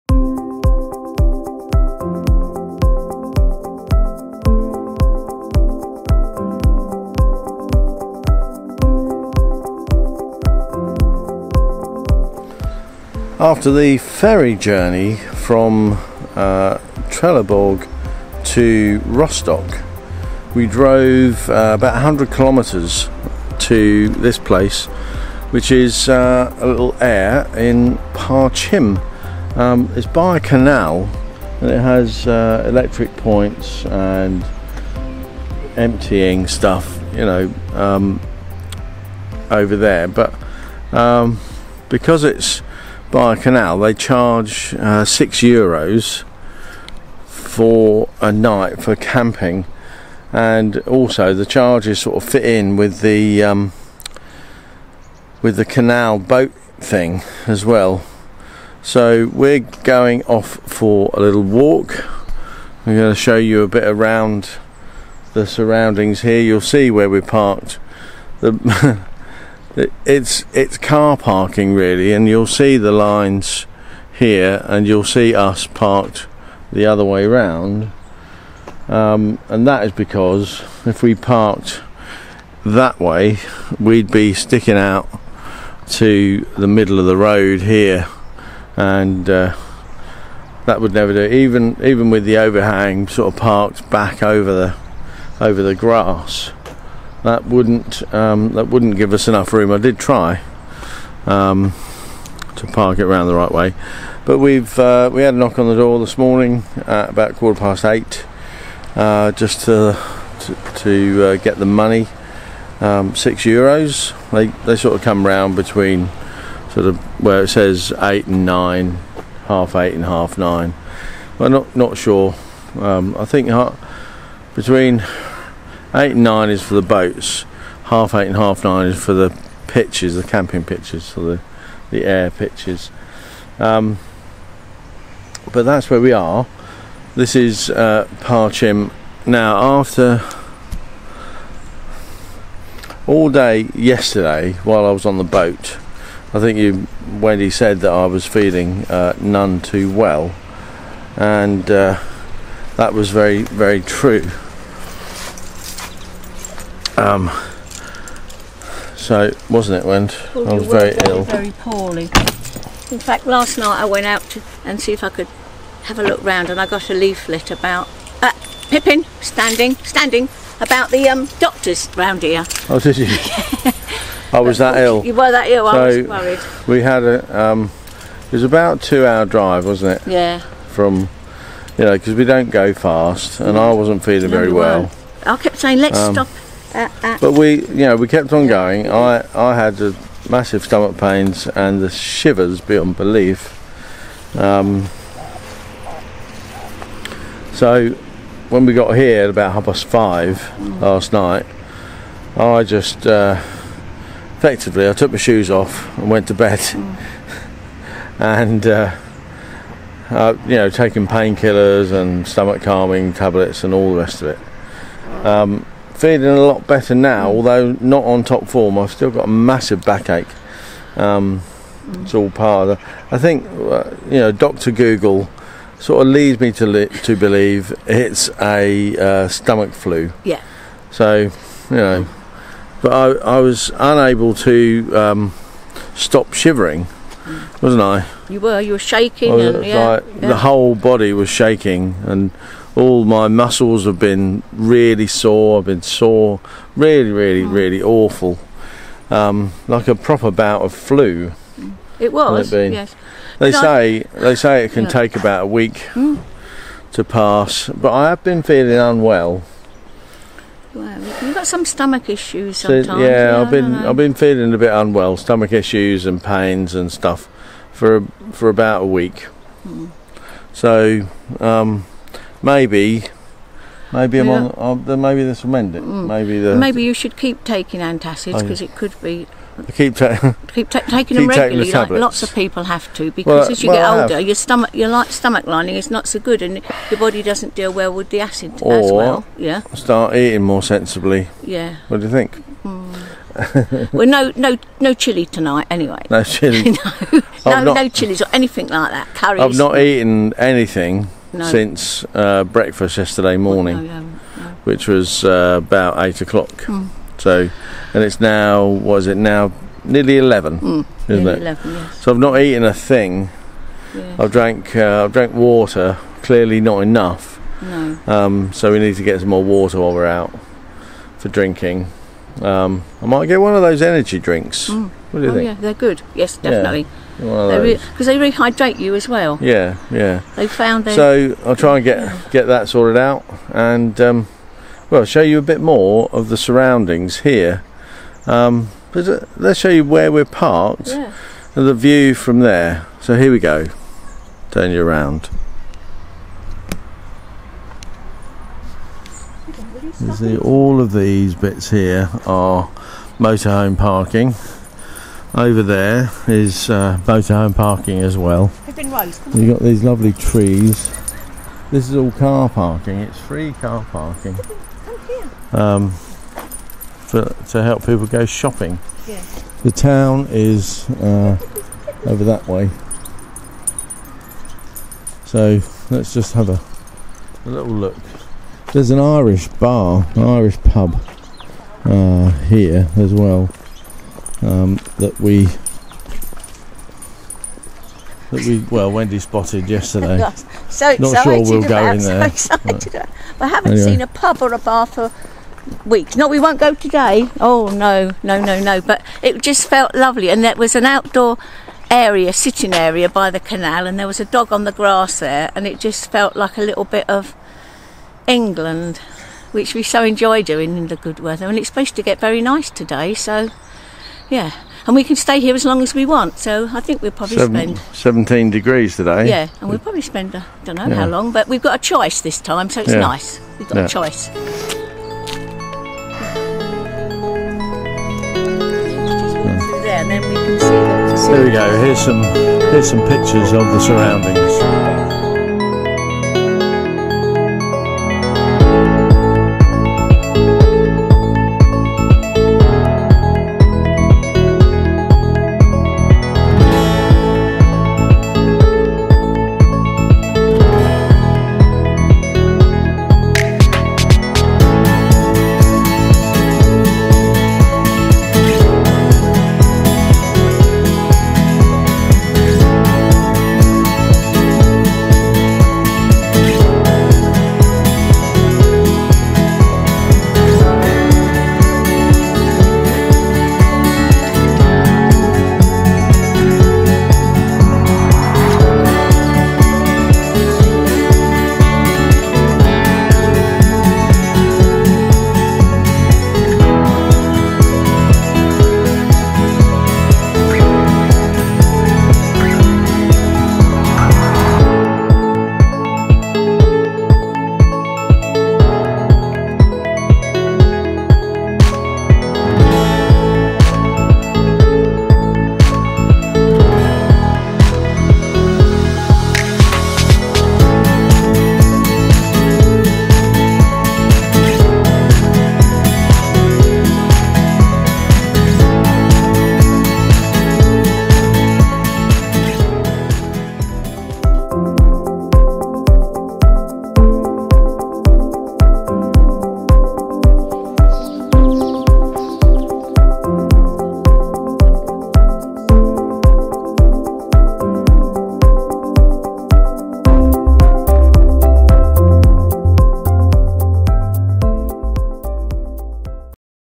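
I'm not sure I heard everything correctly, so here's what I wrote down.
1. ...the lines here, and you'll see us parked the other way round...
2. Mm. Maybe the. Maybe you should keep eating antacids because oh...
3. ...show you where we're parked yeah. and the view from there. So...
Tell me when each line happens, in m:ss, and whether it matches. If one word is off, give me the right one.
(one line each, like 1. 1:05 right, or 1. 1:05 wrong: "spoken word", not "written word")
1. 1:12 right
2. 4:35 wrong: "taking", not "eating"
3. 5:39 right.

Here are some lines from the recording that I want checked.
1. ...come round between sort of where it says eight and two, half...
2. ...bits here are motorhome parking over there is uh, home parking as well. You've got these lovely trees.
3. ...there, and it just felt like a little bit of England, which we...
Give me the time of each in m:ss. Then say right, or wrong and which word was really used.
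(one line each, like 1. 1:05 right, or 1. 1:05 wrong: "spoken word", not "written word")
1. 1:55 wrong: "nine", not "two"
2. 5:51 right
3. 6:45 right.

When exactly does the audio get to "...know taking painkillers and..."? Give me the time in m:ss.
3:30.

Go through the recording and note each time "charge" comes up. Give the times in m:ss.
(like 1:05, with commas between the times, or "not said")
0:43, 0:51.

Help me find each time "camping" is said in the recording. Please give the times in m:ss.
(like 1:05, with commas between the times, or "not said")
0:48, 2:10.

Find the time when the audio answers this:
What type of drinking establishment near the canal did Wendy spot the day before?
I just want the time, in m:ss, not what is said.
6:18.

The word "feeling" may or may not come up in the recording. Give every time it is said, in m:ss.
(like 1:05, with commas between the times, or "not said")
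2:28, 3:04, 3:36, 4:18, 4:24.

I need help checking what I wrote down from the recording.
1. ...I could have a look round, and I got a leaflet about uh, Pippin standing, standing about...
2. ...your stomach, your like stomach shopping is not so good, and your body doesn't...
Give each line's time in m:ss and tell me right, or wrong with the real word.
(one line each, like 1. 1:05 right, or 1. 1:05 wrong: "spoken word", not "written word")
1. 2:45 right
2. 4:44 wrong: "lining", not "shopping".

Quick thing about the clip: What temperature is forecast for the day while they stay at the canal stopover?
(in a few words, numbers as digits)
17 degrees.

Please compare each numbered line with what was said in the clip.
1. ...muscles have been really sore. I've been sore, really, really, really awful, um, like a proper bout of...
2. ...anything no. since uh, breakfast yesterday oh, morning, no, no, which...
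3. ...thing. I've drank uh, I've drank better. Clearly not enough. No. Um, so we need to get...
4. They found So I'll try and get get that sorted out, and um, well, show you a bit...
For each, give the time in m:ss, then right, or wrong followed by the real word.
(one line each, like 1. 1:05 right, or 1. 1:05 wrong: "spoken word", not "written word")
1. 4:03 right
2. 5:00 right
3. 5:12 wrong: "water", not "better"
4. 5:30 right.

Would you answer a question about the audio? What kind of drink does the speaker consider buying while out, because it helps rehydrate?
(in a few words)
Energy drinks.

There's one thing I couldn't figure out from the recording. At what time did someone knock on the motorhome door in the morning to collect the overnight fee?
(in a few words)
Quarter past eight.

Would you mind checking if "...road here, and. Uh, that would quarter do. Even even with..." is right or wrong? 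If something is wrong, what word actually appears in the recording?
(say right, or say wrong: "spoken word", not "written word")
wrong: "never", not "quarter".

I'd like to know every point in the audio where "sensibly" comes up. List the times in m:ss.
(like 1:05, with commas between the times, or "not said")
4:50.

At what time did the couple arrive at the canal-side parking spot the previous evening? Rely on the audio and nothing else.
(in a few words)
Half past five.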